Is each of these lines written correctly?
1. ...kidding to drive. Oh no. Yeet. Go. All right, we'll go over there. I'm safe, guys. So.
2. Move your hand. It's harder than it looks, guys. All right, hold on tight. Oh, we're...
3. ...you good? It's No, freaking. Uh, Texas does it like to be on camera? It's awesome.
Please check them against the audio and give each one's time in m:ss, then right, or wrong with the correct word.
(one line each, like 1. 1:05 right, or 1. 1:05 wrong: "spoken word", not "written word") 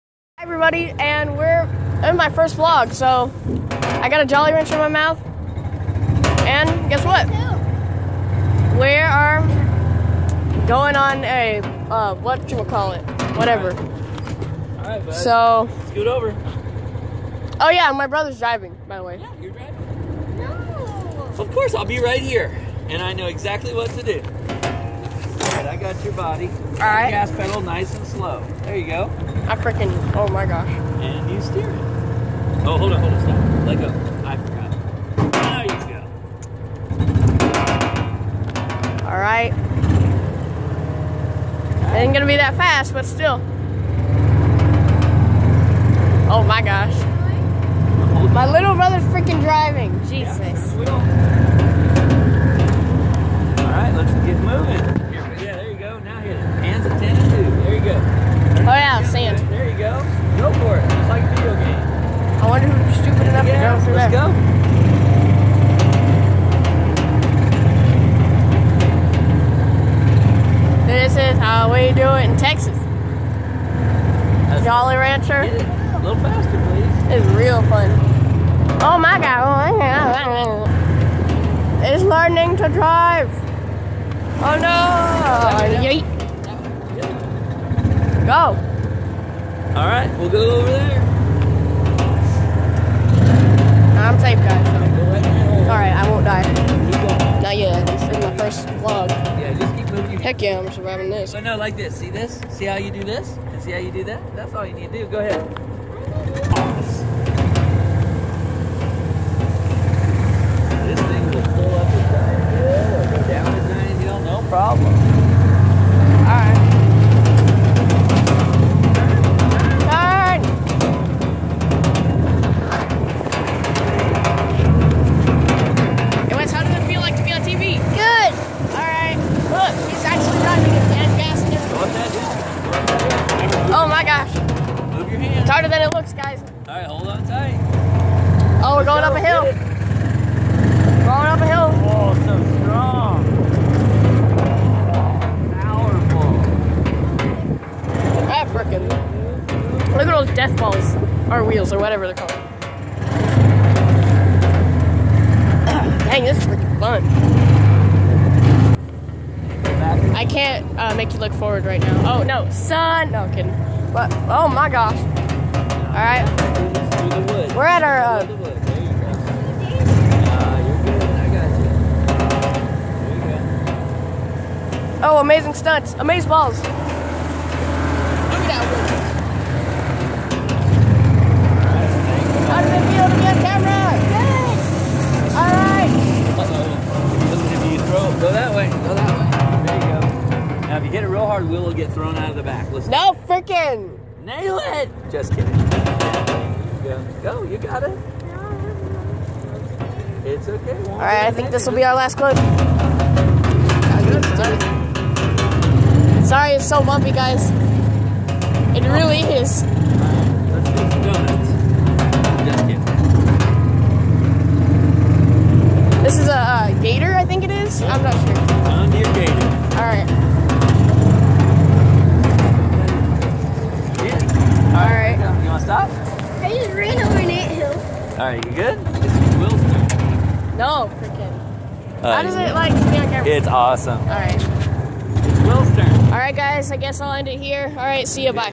1. 1:22 wrong: "learning", not "kidding"
2. 2:14 right
3. 3:48 wrong: "How", not "Texas".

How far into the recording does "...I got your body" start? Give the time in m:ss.
0:25.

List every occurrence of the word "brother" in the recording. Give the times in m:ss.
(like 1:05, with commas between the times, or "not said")
0:18, 0:48.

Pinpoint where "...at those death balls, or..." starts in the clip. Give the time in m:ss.
2:30.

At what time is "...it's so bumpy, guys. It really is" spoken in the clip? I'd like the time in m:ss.
3:26.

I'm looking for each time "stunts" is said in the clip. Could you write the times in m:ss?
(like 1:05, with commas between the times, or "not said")
2:55.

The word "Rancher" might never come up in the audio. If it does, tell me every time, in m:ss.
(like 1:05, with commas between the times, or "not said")
0:04, 1:14.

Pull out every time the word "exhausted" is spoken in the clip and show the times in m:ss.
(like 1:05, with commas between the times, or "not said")
not said.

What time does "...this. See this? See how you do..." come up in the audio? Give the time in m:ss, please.
1:41.